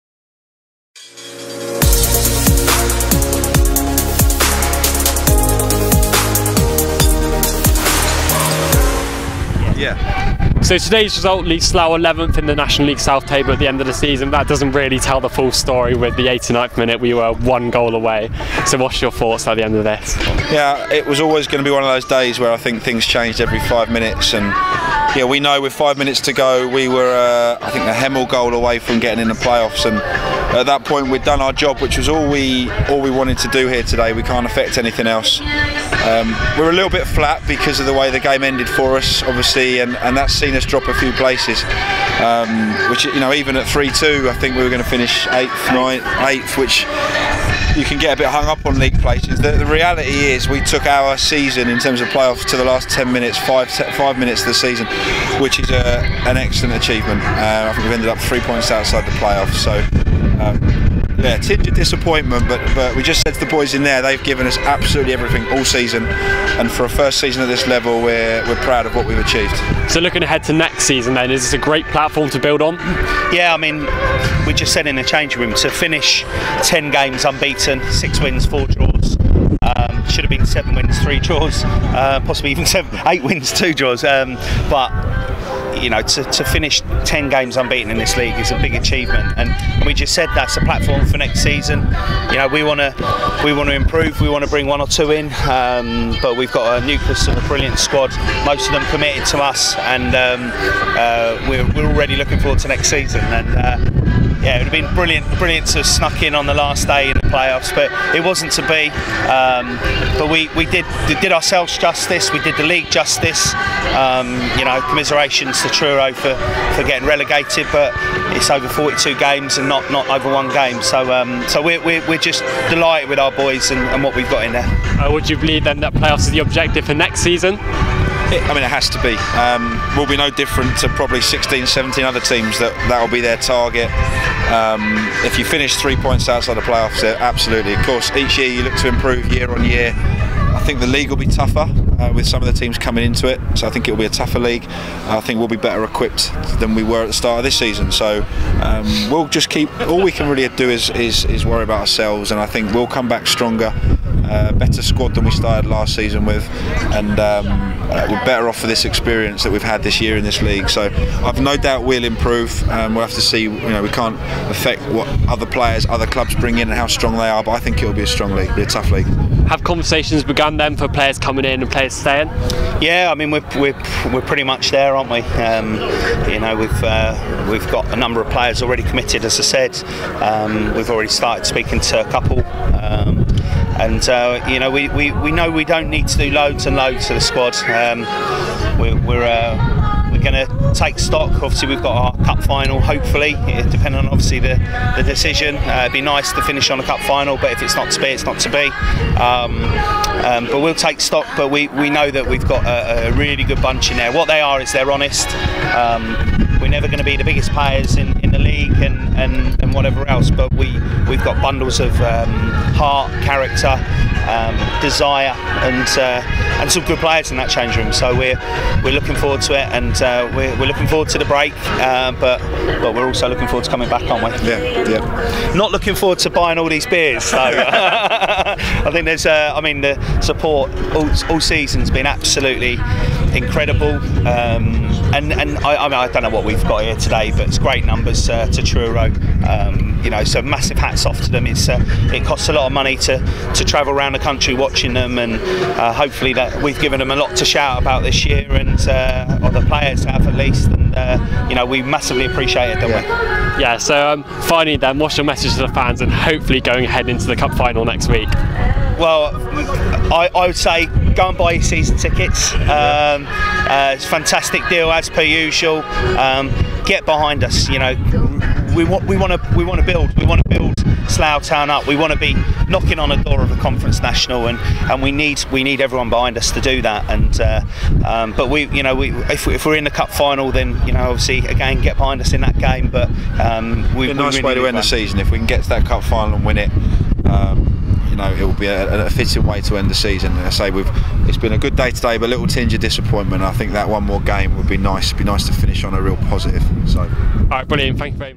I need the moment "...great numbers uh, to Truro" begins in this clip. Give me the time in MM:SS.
03:57.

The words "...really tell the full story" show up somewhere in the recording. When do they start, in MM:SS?
00:14.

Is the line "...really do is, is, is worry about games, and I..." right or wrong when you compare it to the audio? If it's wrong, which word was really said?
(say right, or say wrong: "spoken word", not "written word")
wrong: "ourselves", not "games".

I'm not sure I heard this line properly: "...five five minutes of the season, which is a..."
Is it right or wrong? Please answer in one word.
right.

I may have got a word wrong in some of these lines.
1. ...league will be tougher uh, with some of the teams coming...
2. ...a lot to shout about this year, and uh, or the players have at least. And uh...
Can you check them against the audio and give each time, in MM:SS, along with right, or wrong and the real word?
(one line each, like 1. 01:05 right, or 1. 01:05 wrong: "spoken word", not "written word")
1. 02:20 right
2. 04:07 right.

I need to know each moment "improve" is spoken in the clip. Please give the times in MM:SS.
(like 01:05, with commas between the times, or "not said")
01:33, 02:18, 02:42.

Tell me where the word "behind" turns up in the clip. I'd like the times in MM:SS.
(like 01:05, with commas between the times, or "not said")
04:27, 04:36, 04:41.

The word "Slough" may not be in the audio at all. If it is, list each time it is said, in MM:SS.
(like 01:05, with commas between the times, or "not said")
00:11, 04:31.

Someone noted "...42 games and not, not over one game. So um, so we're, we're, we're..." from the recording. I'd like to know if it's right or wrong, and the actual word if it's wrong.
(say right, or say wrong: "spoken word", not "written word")
right.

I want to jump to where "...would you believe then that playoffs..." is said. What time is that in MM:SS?
02:05.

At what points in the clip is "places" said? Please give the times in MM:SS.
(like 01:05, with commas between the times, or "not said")
00:41, 00:48.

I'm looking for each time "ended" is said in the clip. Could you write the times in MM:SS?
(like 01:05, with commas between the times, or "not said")
00:38, 00:57.